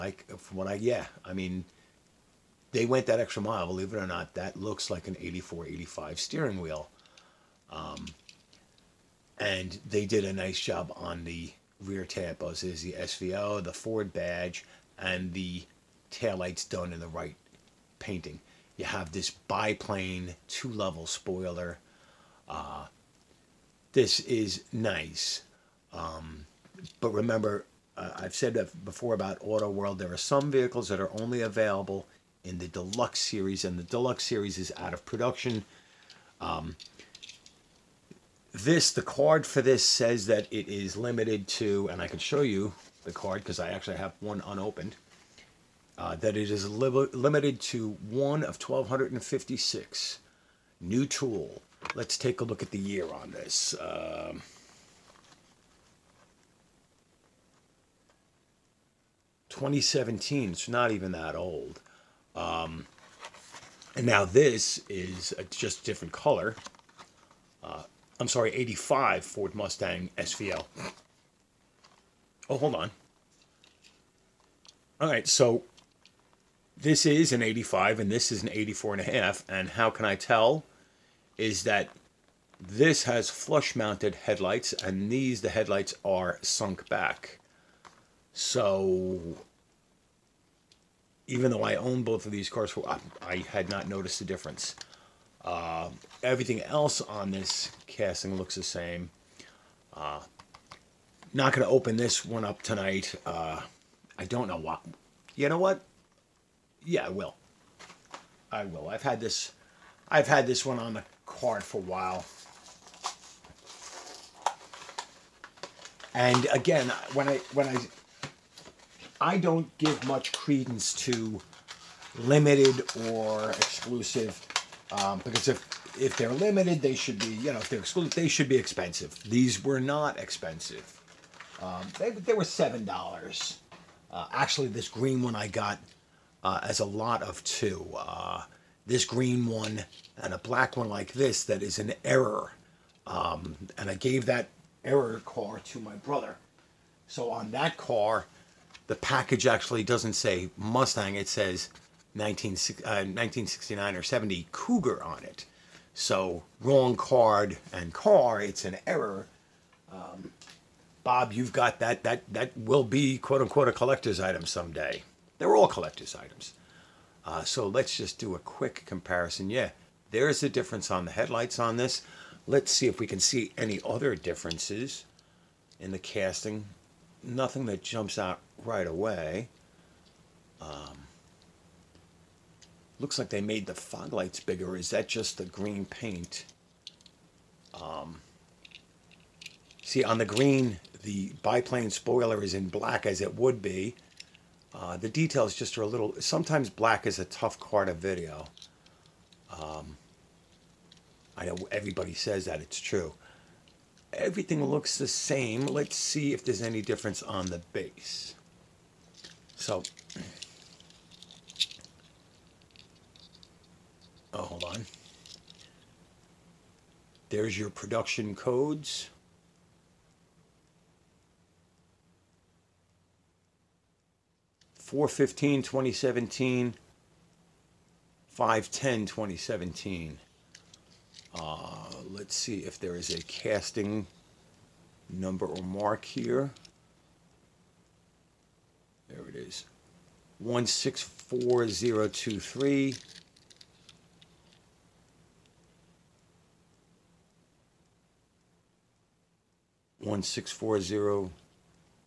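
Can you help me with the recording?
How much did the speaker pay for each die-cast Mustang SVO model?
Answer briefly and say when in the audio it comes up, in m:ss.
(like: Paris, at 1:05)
7 dollars, at 2:12.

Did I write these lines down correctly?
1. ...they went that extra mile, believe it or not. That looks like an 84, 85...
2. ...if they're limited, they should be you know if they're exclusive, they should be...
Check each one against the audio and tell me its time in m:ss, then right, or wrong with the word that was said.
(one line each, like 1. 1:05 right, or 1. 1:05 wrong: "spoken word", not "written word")
1. 0:02 right
2. 2:05 right.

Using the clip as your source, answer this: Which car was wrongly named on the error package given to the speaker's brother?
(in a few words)
1969 or 70 Cougar.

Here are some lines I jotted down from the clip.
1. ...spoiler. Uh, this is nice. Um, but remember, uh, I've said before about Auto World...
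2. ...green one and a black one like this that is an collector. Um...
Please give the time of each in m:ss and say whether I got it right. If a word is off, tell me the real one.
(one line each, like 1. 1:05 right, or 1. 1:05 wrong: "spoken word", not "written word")
1. 0:21 right
2. 2:19 wrong: "error", not "collector".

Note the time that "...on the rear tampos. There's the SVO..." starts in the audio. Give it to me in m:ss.
0:10.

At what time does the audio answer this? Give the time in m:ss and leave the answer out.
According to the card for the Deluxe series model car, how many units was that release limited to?
0:48.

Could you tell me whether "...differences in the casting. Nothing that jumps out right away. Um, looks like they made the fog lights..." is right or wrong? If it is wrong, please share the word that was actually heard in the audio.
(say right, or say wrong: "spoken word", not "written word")
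right.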